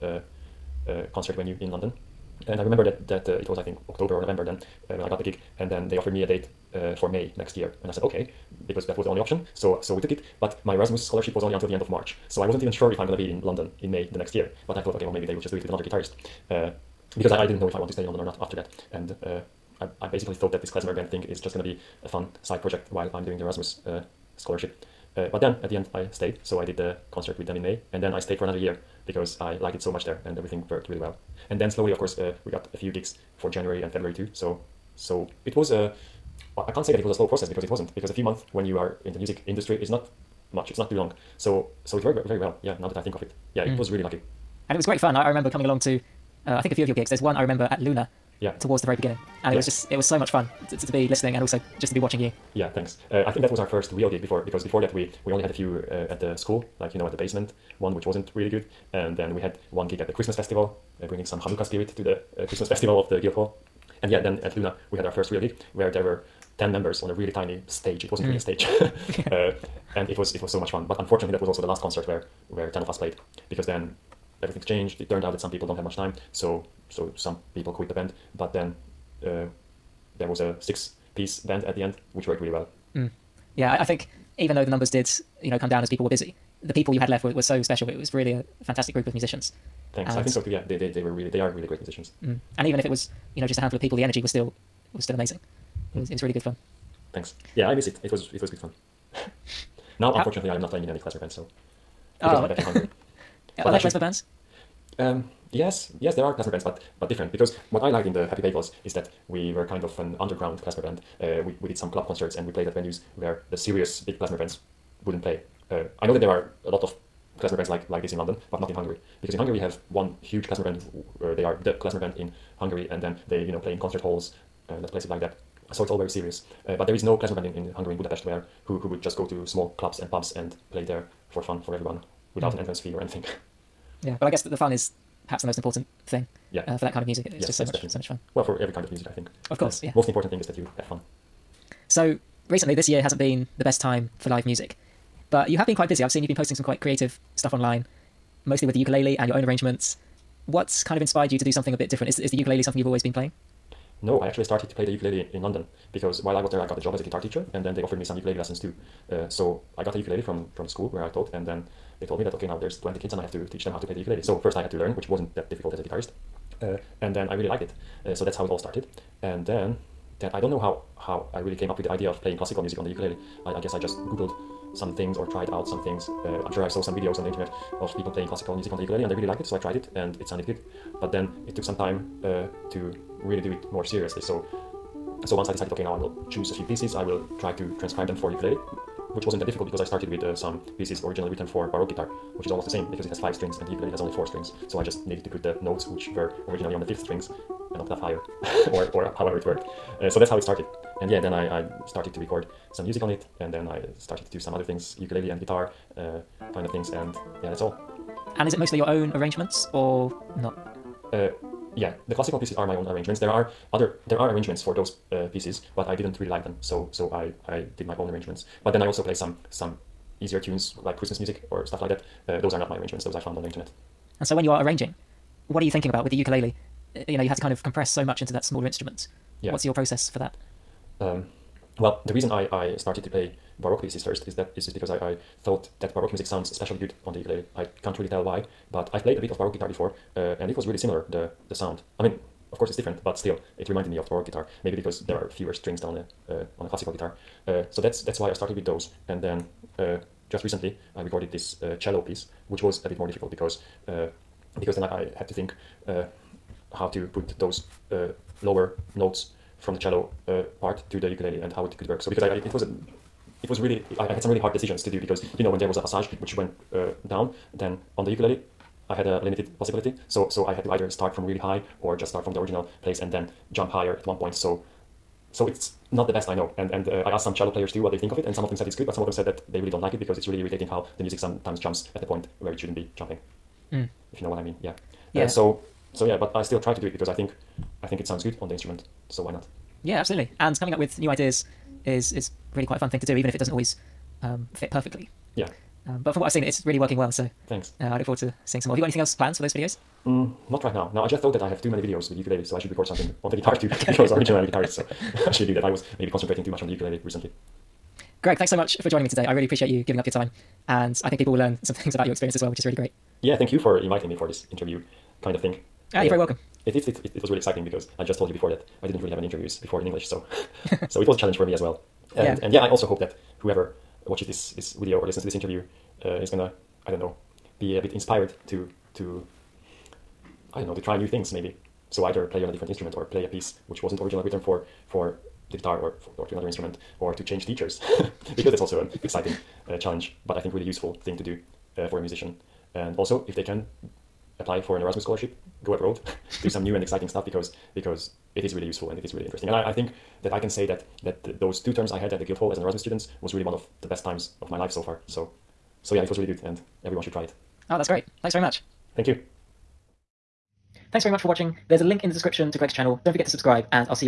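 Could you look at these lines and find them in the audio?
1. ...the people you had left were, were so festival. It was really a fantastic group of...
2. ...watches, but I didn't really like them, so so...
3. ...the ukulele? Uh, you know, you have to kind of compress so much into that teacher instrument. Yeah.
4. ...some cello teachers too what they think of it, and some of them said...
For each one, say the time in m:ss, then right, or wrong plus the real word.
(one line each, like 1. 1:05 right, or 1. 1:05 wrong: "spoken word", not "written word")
1. 1:26 wrong: "special", not "festival"
2. 3:35 wrong: "pieces", not "watches"
3. 3:46 wrong: "smaller", not "teacher"
4. 4:37 wrong: "players", not "teachers".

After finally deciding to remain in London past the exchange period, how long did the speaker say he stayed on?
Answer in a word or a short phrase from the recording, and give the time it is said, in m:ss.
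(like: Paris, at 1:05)
Another year, at 0:28.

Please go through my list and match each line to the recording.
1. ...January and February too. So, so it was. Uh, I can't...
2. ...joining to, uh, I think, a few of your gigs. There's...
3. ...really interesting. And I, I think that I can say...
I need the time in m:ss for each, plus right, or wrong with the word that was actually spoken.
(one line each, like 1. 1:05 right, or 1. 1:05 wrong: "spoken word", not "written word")
1. 0:33 right
2. 0:45 wrong: "along", not "joining"
3. 5:49 right.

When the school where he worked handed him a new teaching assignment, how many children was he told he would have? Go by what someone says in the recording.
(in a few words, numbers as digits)
20.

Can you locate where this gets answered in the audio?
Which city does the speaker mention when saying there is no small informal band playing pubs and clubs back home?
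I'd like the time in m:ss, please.
2:07.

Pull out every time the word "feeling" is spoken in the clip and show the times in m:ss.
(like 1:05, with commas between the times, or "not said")
not said.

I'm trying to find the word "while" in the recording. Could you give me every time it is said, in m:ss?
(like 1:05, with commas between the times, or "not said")
0:22, 2:36.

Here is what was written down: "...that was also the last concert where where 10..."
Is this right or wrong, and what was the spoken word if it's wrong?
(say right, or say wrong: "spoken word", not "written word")
right.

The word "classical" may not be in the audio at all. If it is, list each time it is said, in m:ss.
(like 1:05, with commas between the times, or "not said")
2:52, 2:58, 3:32, 4:06.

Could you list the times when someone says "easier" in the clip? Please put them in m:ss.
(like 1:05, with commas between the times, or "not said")
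3:40.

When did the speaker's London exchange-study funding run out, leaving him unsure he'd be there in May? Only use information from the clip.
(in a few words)
End of March.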